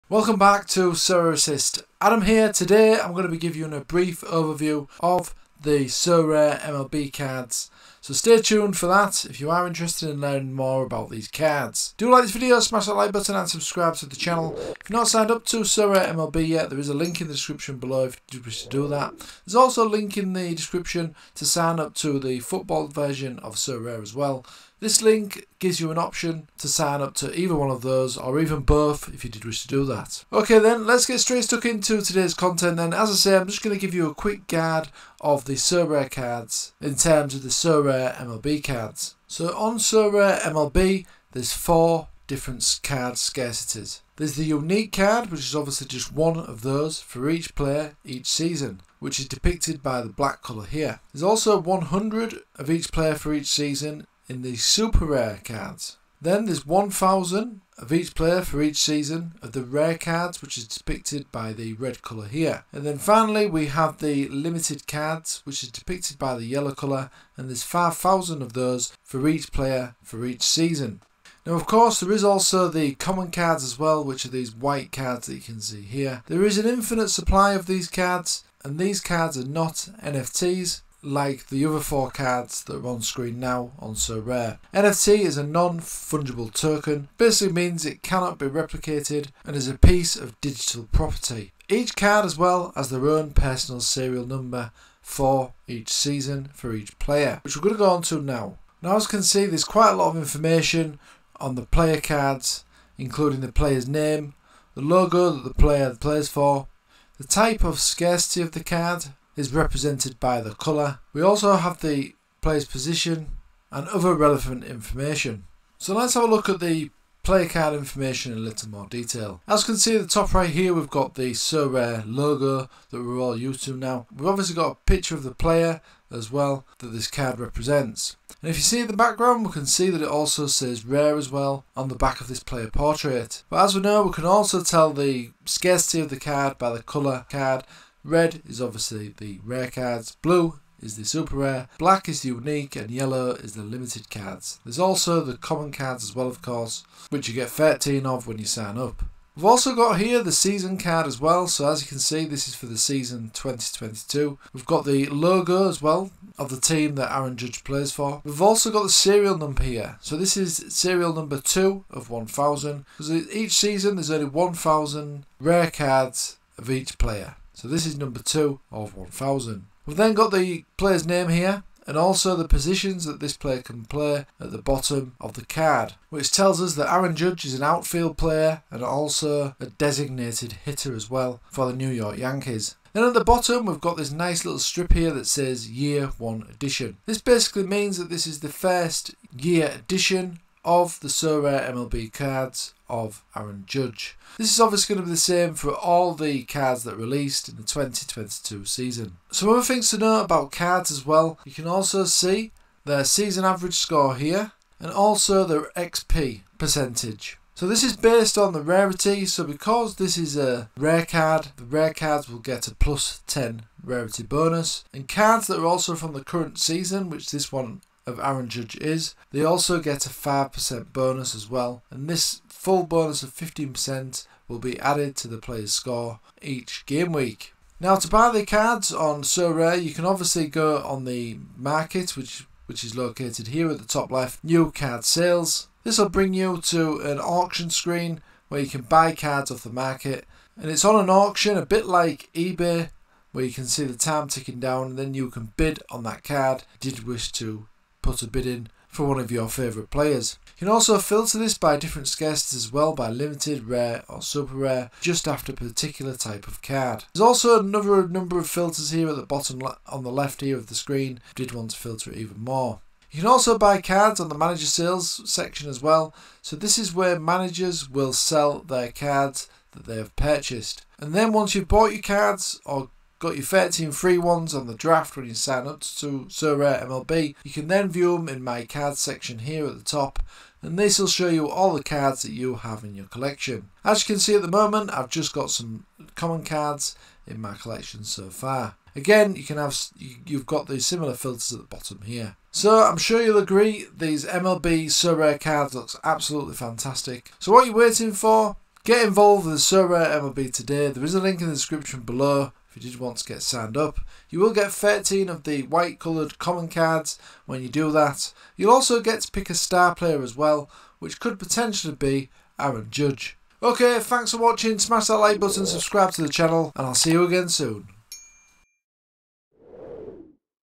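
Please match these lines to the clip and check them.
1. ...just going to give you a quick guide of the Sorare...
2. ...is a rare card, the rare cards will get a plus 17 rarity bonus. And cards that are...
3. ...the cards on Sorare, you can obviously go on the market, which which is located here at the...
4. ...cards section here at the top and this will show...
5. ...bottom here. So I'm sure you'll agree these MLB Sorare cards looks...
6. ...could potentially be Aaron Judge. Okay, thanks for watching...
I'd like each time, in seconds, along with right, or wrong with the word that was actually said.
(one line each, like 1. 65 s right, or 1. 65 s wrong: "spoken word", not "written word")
1. 33 s right
2. 210 s wrong: "10", not "17"
3. 228 s right
4. 278 s right
5. 291 s right
6. 311 s right.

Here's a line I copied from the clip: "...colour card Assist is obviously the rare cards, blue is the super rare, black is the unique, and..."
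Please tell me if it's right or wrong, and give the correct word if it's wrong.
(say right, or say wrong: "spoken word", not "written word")
wrong: "Red", not "Assist".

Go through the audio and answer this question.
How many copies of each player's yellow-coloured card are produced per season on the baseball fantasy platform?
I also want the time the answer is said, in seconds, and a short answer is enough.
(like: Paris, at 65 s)
5000, at 67 s.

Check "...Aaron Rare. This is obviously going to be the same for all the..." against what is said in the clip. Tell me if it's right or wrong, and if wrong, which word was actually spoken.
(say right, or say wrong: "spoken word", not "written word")
wrong: "Judge", not "Rare".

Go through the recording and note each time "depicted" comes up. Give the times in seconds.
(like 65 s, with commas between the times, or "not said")
49 s, 60 s, 65 s.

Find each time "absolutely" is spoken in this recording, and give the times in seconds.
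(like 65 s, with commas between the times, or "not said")
296 s.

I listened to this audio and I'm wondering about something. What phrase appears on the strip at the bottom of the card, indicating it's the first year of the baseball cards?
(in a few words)
Year 1 Edition.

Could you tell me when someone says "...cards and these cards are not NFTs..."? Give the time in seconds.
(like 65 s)
77 s.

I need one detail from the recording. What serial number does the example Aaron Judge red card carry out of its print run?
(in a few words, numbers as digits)
2.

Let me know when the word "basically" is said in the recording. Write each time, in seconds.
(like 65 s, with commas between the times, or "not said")
87 s, 187 s.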